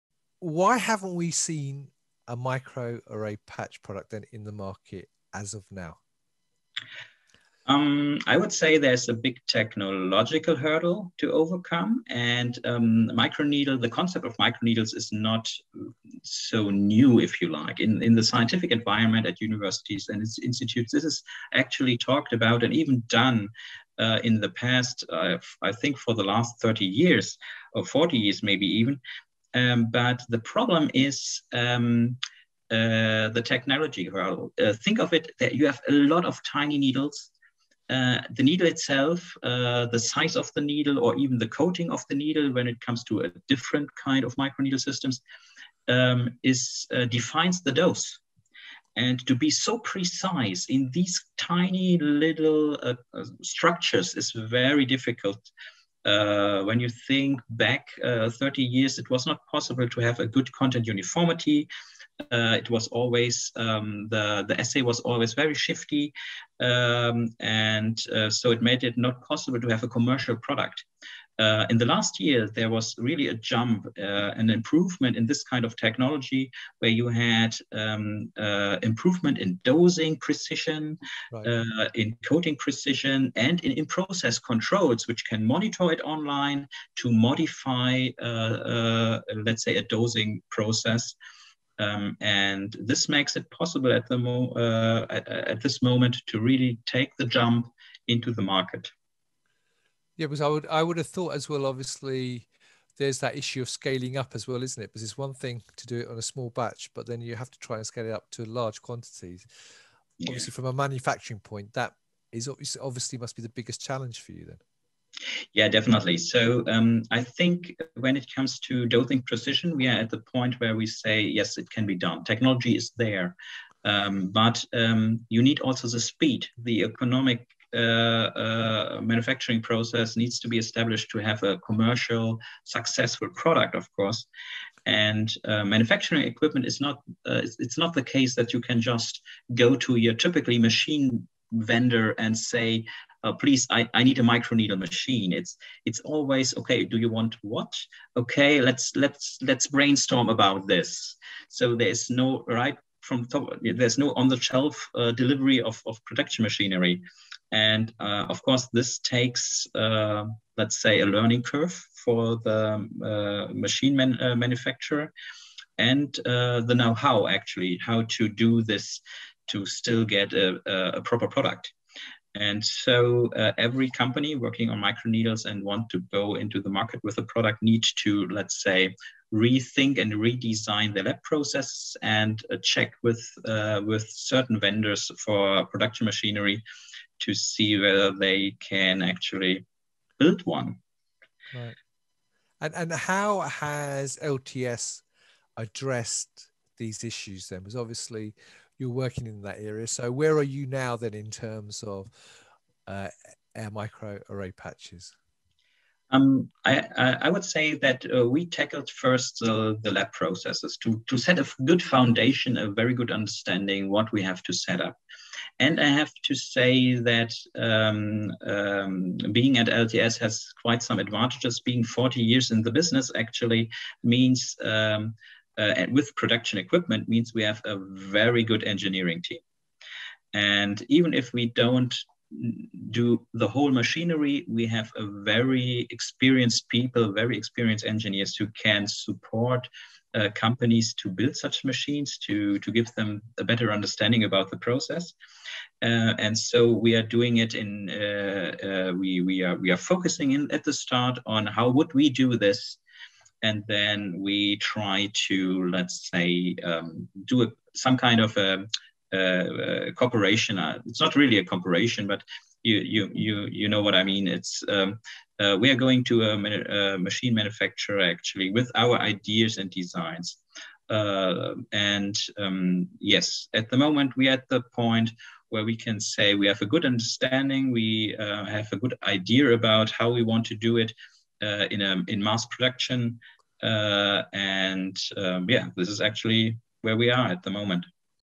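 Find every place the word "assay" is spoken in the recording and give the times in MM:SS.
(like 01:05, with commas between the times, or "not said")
01:04.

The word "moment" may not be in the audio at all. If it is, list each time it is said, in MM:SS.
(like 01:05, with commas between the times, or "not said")
01:35, 04:33, 04:47.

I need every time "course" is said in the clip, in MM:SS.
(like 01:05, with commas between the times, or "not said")
02:13, 02:38.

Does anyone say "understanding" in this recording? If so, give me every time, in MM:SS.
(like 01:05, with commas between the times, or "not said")
03:33, 04:03, 04:36.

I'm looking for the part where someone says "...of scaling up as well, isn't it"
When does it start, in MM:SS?
01:43.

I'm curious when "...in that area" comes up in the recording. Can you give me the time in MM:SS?
03:19.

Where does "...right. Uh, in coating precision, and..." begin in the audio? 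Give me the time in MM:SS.
01:21.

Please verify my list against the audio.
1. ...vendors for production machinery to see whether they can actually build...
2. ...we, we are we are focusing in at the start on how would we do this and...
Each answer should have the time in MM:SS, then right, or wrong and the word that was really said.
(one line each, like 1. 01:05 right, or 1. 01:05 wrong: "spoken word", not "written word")
1. 03:04 right
2. 04:08 right.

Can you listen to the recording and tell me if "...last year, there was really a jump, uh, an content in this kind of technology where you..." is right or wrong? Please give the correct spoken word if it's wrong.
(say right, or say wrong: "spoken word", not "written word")
wrong: "improvement", not "content".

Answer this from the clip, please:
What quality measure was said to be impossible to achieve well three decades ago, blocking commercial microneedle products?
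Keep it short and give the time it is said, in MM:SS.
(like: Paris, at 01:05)
content uniformity, at 01:00.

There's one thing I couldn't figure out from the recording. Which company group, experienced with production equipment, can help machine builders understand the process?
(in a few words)
engineering team.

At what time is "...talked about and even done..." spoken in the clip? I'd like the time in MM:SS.
00:21.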